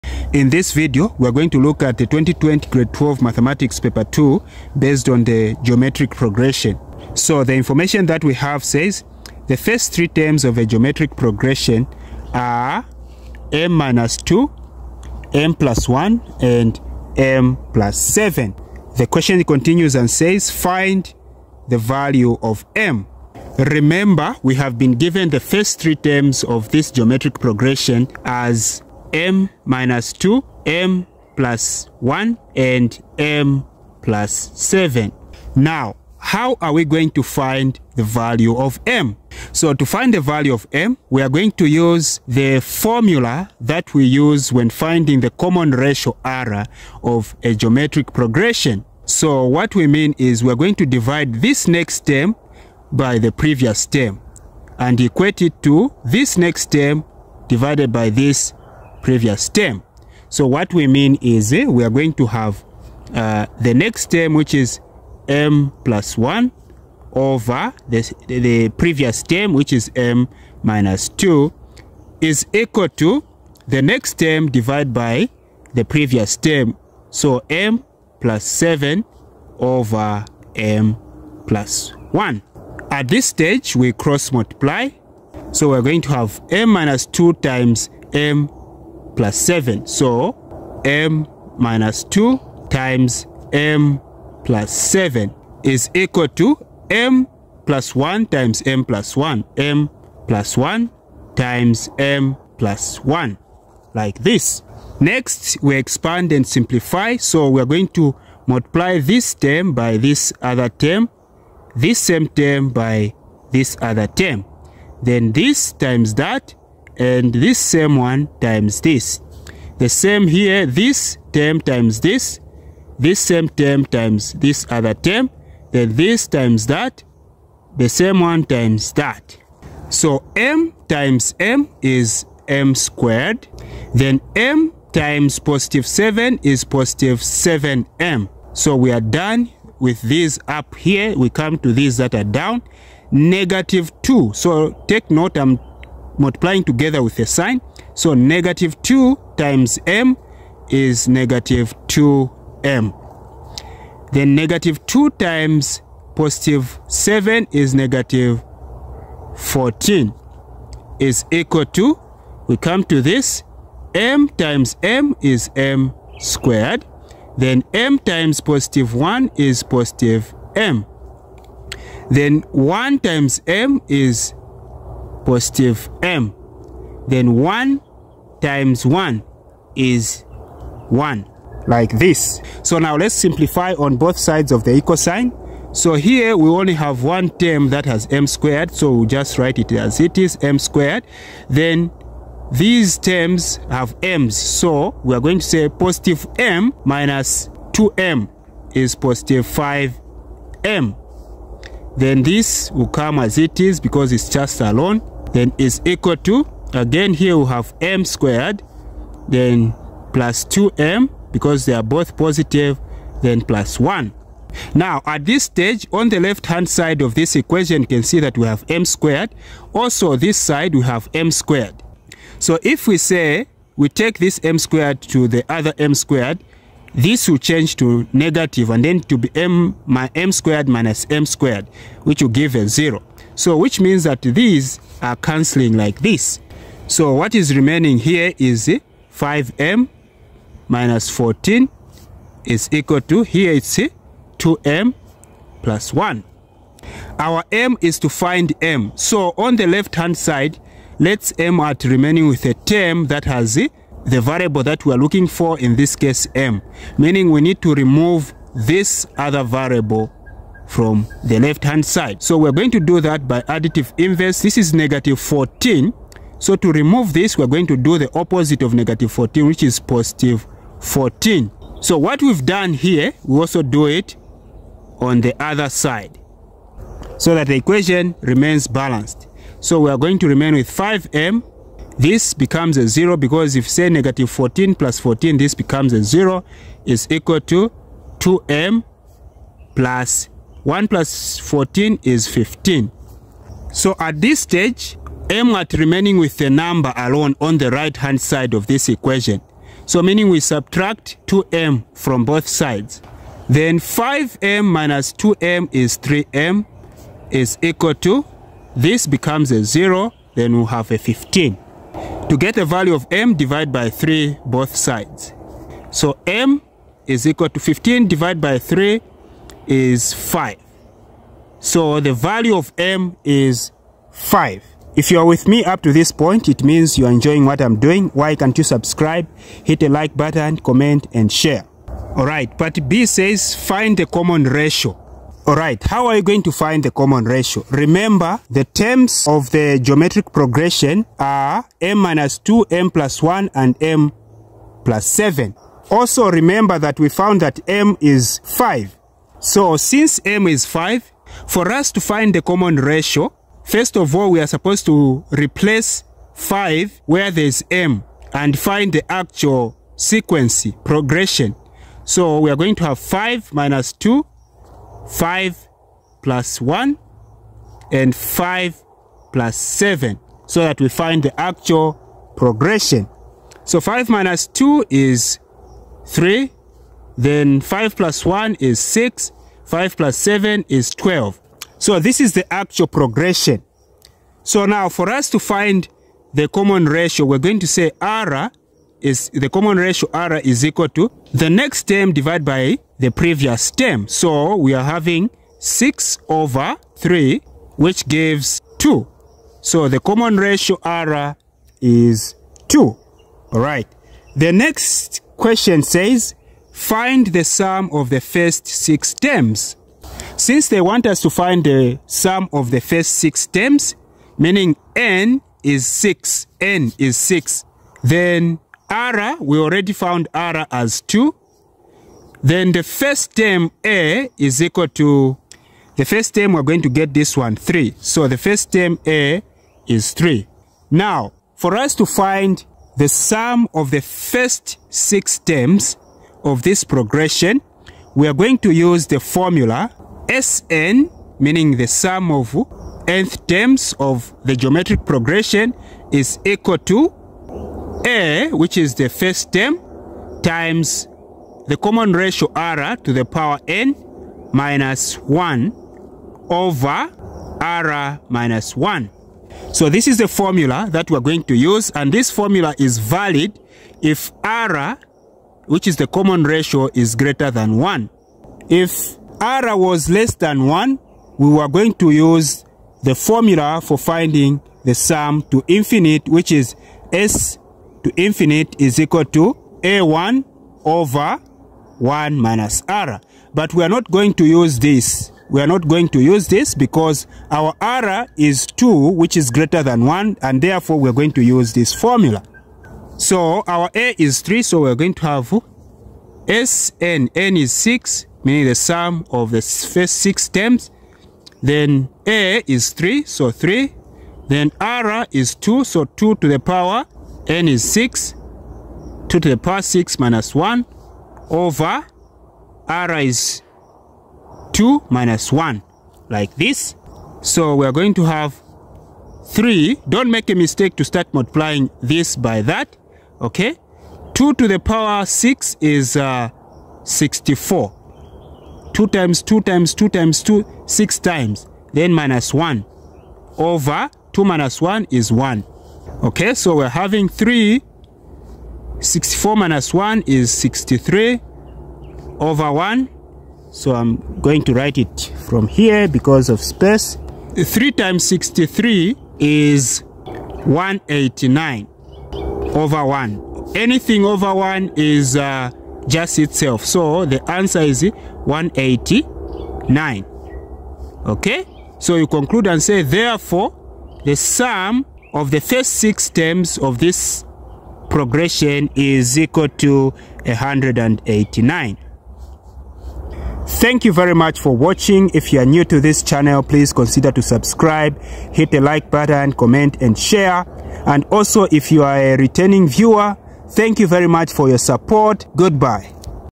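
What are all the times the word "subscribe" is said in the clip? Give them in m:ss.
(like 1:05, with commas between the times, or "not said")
5:28, 9:37.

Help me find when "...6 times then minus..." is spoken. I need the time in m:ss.
8:50.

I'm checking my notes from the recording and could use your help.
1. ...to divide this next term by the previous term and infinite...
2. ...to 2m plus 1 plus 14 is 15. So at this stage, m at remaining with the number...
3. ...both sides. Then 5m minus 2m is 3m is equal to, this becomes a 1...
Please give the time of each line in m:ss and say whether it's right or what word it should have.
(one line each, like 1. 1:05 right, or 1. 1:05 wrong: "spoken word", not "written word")
1. 0:50 wrong: "equate", not "infinite"
2. 4:47 right
3. 5:02 wrong: "0", not "1".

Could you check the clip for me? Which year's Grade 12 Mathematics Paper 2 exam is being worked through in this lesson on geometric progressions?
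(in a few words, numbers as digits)
2020.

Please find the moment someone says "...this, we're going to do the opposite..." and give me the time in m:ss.
4:27.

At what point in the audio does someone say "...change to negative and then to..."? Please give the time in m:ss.
3:47.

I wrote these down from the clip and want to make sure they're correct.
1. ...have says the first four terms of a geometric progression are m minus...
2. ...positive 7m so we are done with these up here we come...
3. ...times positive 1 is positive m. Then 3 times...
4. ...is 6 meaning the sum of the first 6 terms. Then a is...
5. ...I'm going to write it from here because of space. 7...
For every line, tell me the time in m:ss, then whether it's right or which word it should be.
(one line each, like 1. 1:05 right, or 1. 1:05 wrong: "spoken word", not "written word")
1. 0:08 wrong: "three", not "four"
2. 2:16 right
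3. 2:47 wrong: "1", not "3"
4. 8:17 right
5. 9:03 wrong: "3", not "7".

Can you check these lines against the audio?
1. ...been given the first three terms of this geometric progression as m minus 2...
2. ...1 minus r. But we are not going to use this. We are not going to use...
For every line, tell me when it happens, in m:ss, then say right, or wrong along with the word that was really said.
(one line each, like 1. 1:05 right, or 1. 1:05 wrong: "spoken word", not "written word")
1. 0:24 right
2. 8:01 right.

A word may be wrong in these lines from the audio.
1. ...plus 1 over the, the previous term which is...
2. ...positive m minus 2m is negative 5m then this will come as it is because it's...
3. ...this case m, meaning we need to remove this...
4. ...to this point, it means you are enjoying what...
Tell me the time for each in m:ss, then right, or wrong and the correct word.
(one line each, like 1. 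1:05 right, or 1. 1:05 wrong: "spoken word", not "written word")
1. 1:05 right
2. 3:15 wrong: "positive", not "negative"
3. 4:15 right
4. 5:25 right.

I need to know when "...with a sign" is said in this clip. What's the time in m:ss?
2:27.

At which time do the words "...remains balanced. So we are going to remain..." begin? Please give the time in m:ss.
4:38.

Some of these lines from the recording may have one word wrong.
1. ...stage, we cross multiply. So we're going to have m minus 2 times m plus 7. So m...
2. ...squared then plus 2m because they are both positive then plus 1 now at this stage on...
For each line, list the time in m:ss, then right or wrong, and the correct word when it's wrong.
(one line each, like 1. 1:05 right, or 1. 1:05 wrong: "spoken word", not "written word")
1. 1:23 right
2. 3:28 right.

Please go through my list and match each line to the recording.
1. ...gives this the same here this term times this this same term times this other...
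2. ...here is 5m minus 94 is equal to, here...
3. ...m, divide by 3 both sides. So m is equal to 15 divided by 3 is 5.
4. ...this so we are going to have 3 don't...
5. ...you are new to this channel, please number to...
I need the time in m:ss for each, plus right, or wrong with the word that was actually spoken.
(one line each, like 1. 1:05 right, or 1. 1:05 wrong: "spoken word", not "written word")
1. 1:58 wrong: "times", not "gives"
2. 3:57 wrong: "14", not "94"
3. 5:13 right
4. 8:36 right
5. 9:35 wrong: "consider", not "number".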